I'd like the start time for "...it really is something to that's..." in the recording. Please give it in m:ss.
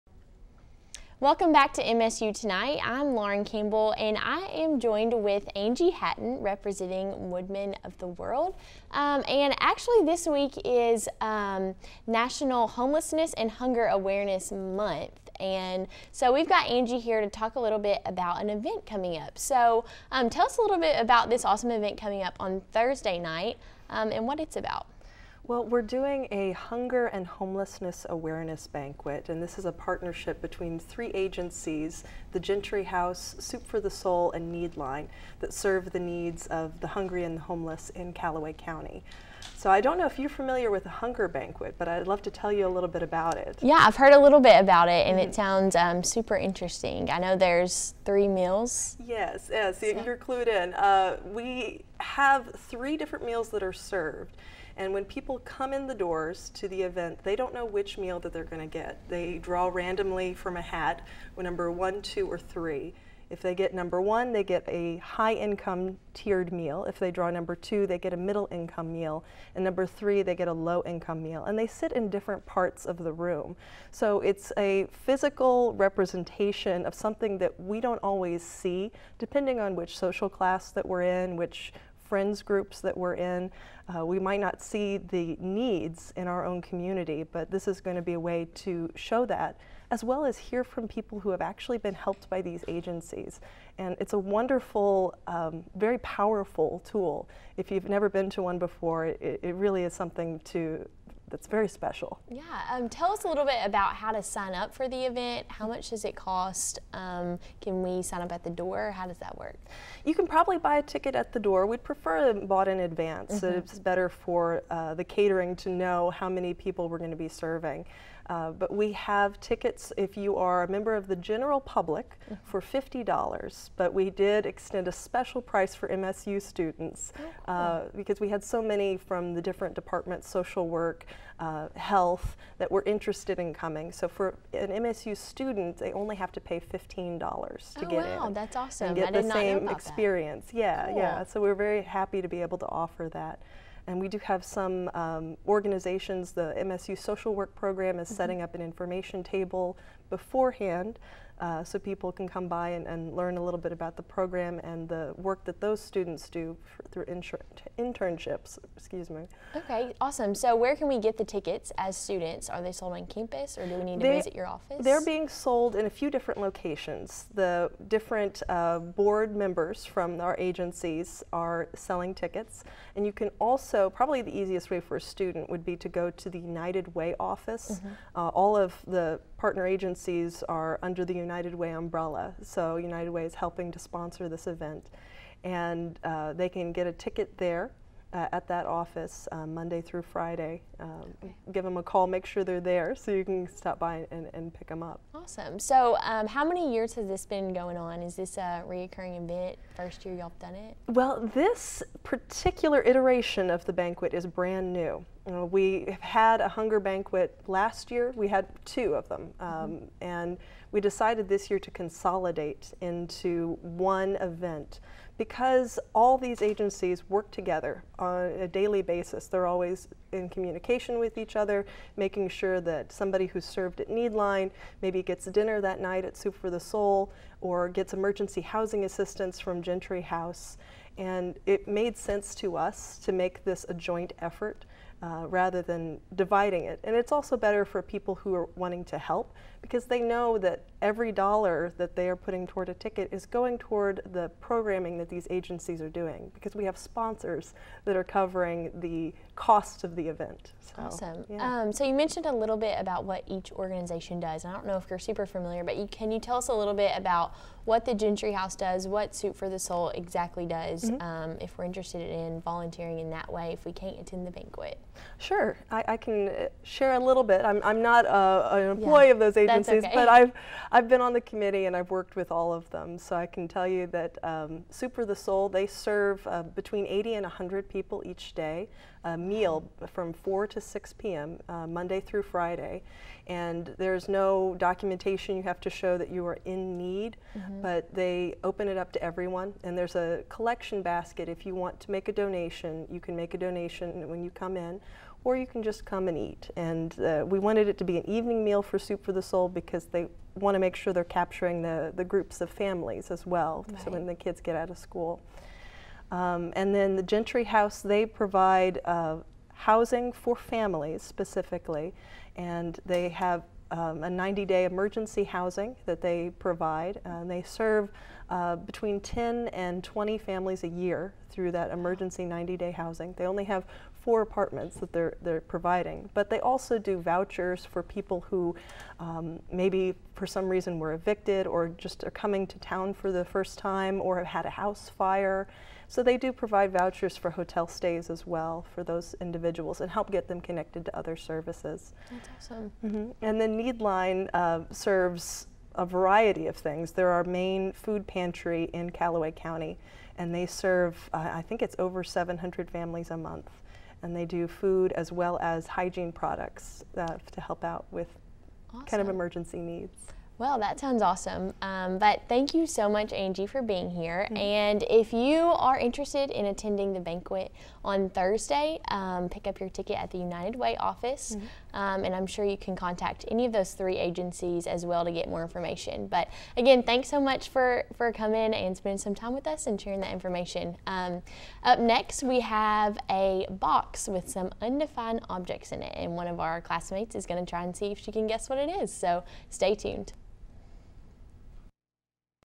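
1:39.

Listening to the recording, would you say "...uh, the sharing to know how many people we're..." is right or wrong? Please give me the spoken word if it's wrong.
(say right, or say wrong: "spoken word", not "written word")
wrong: "catering", not "sharing".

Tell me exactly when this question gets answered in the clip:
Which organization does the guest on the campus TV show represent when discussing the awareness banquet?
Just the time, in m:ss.
0:07.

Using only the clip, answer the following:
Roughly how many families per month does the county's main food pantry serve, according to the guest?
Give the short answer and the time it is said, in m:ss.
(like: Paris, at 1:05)
over 700, at 5:51.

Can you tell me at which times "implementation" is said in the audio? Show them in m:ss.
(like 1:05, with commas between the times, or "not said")
not said.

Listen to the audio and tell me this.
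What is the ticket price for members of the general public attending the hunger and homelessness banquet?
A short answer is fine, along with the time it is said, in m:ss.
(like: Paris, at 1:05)
$50, at 2:02.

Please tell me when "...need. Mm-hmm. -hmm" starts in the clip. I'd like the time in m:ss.
4:46.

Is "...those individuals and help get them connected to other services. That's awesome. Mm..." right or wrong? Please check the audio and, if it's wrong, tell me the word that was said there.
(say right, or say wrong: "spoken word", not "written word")
right.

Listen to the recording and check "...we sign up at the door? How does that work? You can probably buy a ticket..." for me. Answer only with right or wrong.
right.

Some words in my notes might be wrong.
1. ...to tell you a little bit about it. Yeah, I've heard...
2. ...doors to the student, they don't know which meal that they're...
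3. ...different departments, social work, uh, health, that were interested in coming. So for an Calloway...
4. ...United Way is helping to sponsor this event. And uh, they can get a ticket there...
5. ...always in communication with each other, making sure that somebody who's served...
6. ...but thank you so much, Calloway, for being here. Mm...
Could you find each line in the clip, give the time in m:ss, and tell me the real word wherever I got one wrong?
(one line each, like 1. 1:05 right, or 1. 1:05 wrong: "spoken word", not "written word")
1. 0:42 right
2. 0:55 wrong: "event", not "student"
3. 2:09 wrong: "MSU", not "Calloway"
4. 3:02 right
5. 3:39 right
6. 6:01 wrong: "Angie", not "Calloway".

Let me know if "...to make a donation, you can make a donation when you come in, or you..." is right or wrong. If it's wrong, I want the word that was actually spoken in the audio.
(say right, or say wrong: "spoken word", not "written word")
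right.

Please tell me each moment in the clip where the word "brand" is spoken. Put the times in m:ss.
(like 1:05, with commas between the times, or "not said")
3:24.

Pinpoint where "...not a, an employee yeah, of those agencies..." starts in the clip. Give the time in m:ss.
4:27.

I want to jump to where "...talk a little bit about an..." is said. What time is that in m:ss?
0:17.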